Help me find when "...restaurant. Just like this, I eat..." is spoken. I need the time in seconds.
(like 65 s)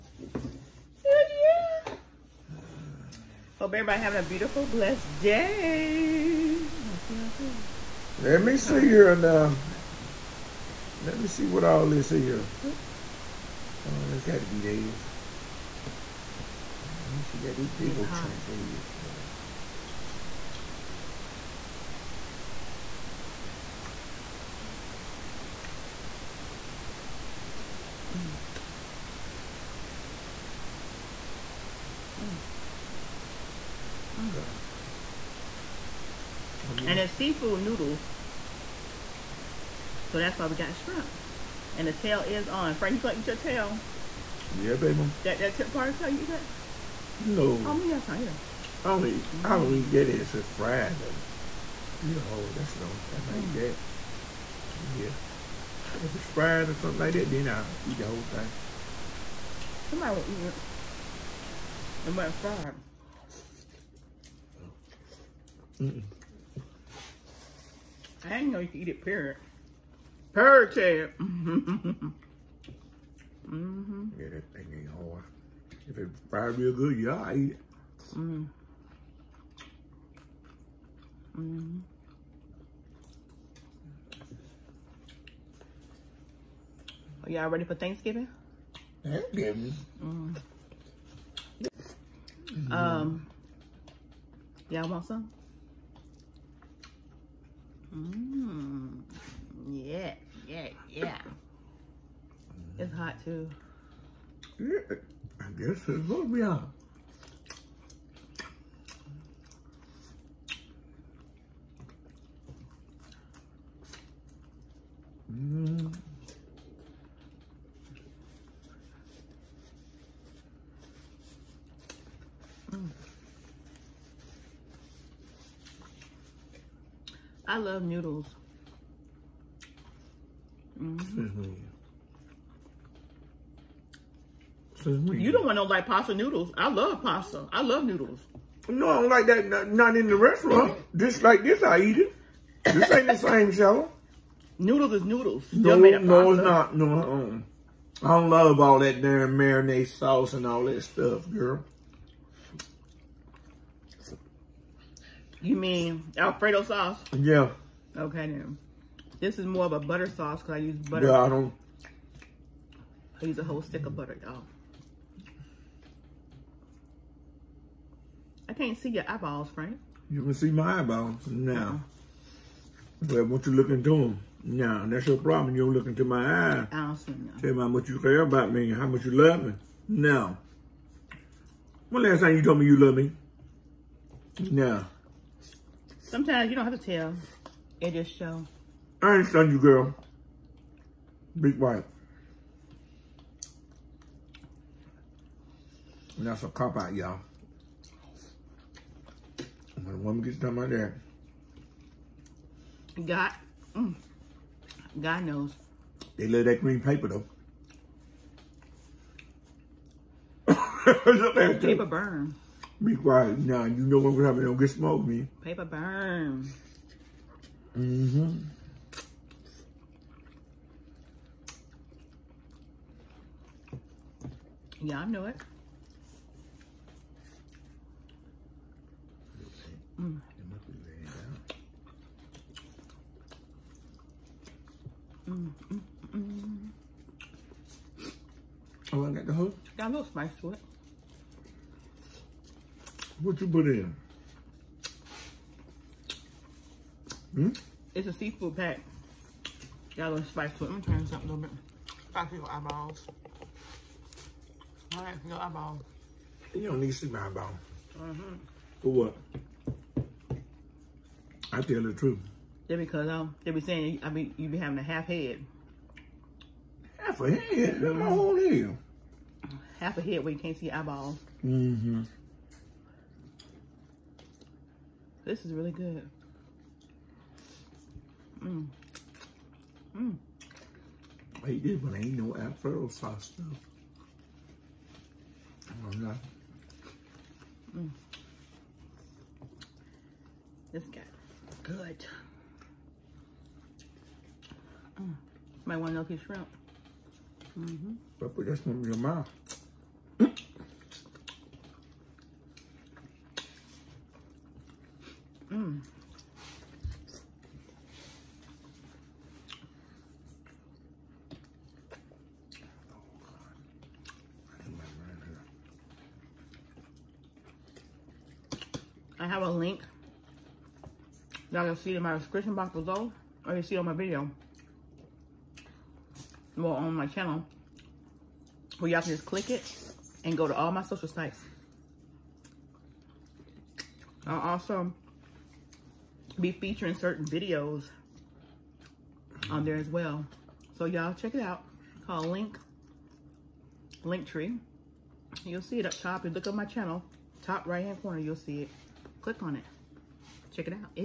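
140 s.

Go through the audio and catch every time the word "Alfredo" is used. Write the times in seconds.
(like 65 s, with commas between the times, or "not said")
156 s, 282 s.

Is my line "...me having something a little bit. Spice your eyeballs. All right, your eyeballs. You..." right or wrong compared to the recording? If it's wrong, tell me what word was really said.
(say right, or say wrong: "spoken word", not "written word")
wrong: "trying", not "having".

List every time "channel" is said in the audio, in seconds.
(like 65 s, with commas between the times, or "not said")
327 s, 346 s.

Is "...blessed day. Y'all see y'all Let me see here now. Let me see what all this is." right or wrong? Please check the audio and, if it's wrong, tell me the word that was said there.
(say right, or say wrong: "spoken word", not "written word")
right.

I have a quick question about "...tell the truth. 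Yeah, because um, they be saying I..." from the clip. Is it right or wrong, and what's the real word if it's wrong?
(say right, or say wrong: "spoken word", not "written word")
right.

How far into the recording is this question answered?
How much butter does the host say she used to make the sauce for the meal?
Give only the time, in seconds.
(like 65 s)
163 s.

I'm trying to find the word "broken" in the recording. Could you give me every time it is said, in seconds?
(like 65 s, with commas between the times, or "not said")
not said.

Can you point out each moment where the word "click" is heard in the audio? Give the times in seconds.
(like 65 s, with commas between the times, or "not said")
329 s, 349 s.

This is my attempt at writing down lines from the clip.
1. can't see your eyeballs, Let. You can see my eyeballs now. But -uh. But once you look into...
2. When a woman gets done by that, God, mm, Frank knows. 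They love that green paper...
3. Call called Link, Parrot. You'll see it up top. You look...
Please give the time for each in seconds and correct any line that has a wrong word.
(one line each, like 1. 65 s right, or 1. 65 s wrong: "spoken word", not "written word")
1. 168 s wrong: "Frank", not "Let"
2. 199 s wrong: "God", not "Frank"
3. 342 s wrong: "Linktree", not "Parrot".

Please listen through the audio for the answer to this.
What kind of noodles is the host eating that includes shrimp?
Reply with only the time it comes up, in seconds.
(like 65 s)
37 s.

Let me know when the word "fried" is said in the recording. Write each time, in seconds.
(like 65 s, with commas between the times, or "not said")
50 s, 56 s, 62 s, 76 s.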